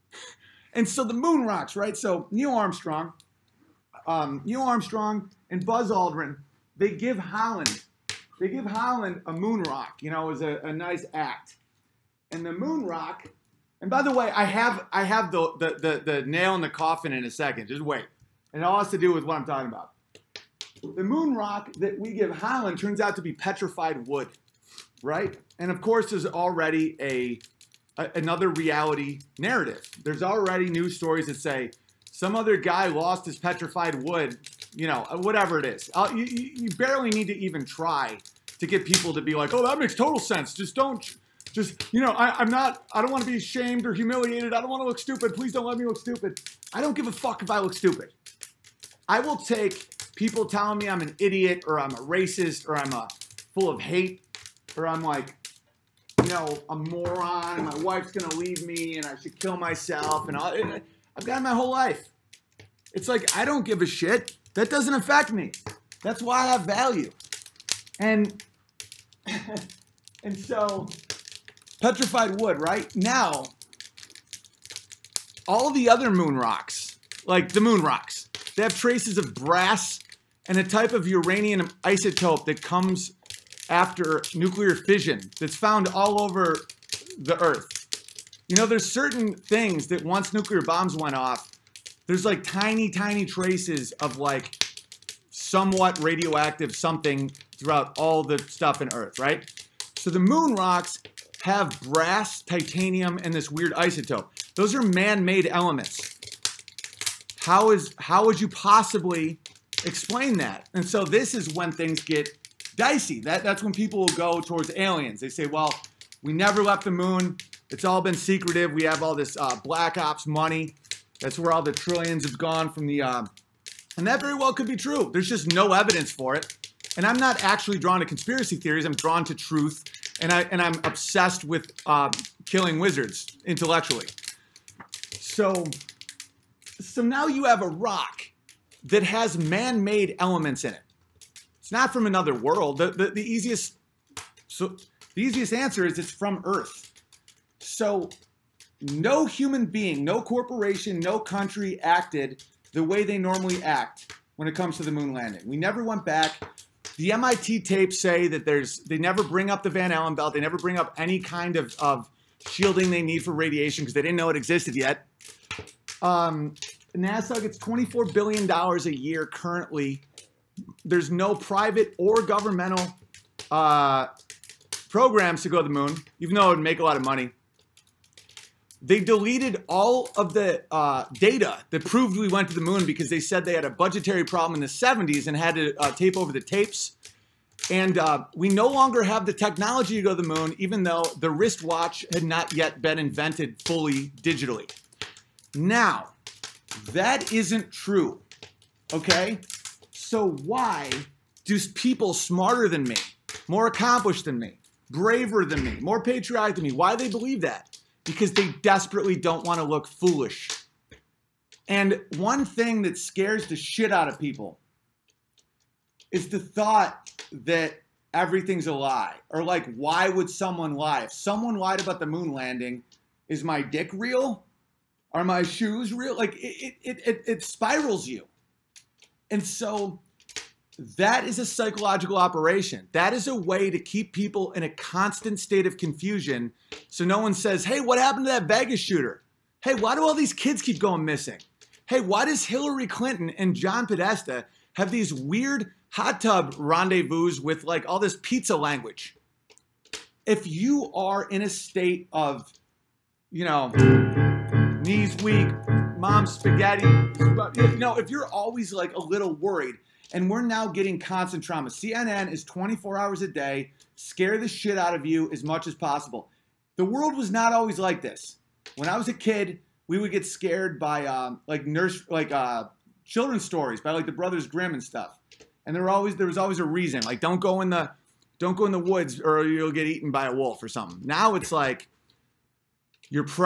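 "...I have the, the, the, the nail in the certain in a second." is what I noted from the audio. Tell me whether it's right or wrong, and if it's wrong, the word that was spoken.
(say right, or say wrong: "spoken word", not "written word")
wrong: "coffin", not "certain".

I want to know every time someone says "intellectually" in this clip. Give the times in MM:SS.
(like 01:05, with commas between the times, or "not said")
02:13.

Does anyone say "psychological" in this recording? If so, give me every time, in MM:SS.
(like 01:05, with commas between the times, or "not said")
03:51.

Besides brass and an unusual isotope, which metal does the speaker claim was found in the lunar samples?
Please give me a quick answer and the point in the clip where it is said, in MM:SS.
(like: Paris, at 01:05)
Titanium, at 01:42.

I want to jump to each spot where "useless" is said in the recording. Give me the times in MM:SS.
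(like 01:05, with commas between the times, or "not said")
not said.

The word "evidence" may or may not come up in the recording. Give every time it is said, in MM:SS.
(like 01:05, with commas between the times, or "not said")
02:05.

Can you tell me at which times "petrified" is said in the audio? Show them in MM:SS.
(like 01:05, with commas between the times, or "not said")
00:23, 00:33, 01:11.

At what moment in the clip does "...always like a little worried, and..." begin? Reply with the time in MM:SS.
04:18.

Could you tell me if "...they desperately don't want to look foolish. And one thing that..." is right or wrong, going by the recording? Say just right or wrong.
right.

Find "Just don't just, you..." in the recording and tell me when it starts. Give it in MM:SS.
00:40.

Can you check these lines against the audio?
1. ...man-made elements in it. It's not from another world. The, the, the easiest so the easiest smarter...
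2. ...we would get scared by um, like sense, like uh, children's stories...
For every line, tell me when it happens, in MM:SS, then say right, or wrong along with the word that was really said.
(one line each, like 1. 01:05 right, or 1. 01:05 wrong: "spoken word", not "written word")
1. 02:19 wrong: "answer", not "smarter"
2. 04:29 wrong: "nurse", not "sense".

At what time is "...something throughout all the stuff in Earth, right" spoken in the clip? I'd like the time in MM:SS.
01:36.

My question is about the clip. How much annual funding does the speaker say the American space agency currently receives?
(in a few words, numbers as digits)
$24 billion.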